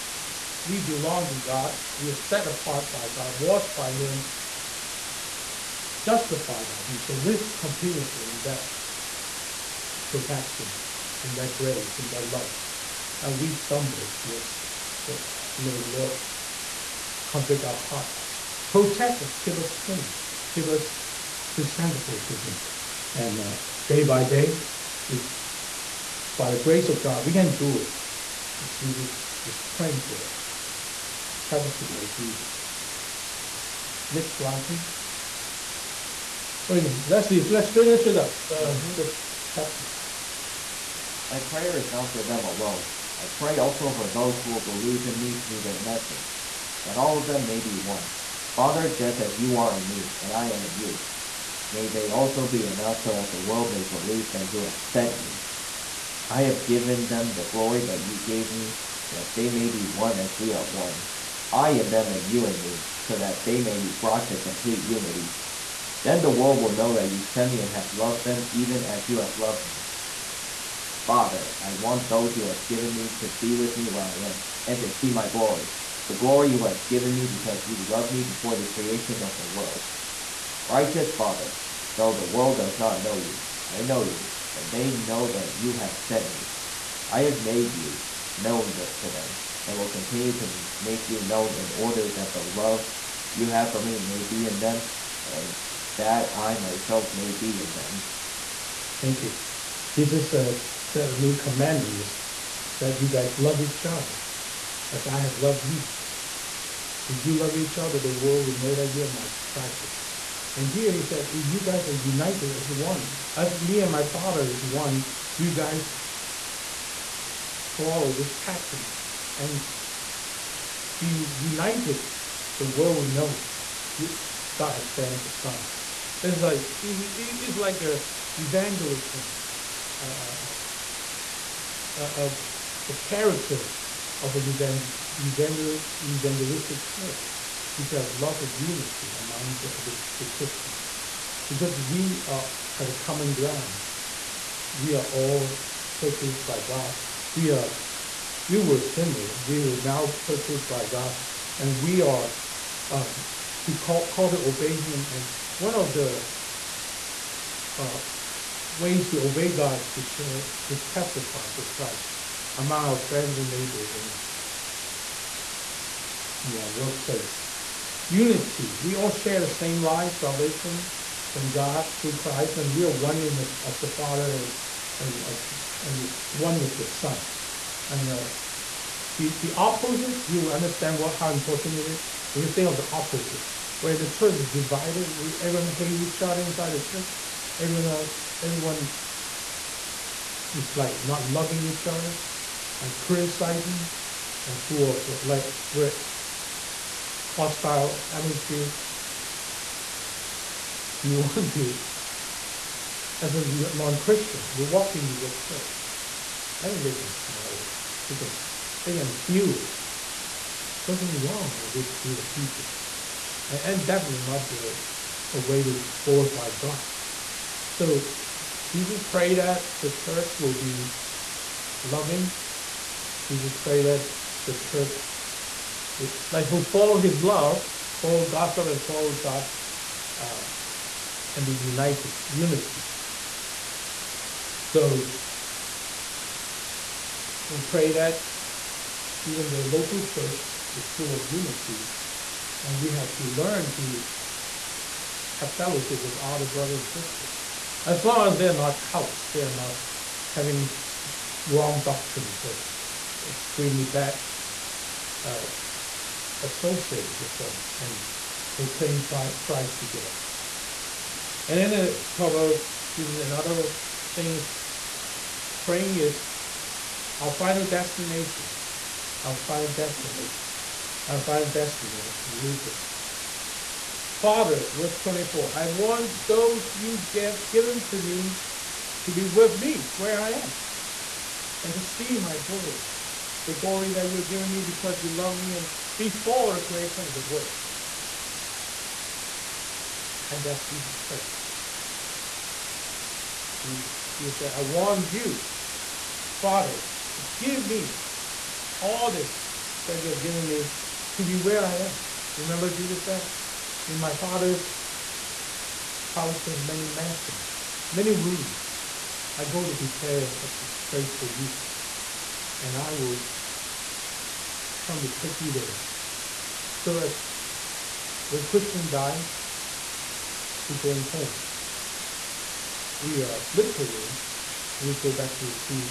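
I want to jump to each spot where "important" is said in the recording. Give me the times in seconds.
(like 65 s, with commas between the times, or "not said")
181 s.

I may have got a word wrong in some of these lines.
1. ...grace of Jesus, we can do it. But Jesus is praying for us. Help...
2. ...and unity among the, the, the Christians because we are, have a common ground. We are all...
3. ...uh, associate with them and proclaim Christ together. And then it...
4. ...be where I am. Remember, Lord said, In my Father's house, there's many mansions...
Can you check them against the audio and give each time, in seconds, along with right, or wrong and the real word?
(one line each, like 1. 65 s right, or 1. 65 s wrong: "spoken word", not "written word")
1. 26 s wrong: "God", not "Jesus"
2. 138 s right
3. 255 s right
4. 301 s wrong: "Jesus", not "Lord".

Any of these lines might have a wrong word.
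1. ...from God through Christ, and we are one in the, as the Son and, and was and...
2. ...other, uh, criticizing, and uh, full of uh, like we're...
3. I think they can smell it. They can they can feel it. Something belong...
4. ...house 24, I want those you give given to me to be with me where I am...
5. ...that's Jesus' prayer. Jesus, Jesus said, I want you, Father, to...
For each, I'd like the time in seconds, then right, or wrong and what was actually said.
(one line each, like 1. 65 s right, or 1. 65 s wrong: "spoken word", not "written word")
1. 171 s wrong: "Father", not "Son"
2. 191 s right
3. 206 s wrong: "wrong", not "belong"
4. 274 s wrong: "verse", not "house"
5. 290 s right.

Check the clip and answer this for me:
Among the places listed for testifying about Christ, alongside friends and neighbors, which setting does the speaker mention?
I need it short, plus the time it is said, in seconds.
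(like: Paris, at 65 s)
workplace, at 166 s.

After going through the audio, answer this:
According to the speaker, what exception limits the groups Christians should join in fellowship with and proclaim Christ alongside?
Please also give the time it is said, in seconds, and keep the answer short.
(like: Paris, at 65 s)
cults, at 248 s.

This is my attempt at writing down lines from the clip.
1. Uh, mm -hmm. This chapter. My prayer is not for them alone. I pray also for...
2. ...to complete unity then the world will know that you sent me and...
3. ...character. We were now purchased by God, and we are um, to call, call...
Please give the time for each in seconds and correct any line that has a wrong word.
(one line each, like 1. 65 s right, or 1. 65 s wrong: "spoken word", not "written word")
1. 38 s right
2. 64 s right
3. 148 s wrong: "sinner", not "character".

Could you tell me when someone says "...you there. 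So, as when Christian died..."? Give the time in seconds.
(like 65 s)
315 s.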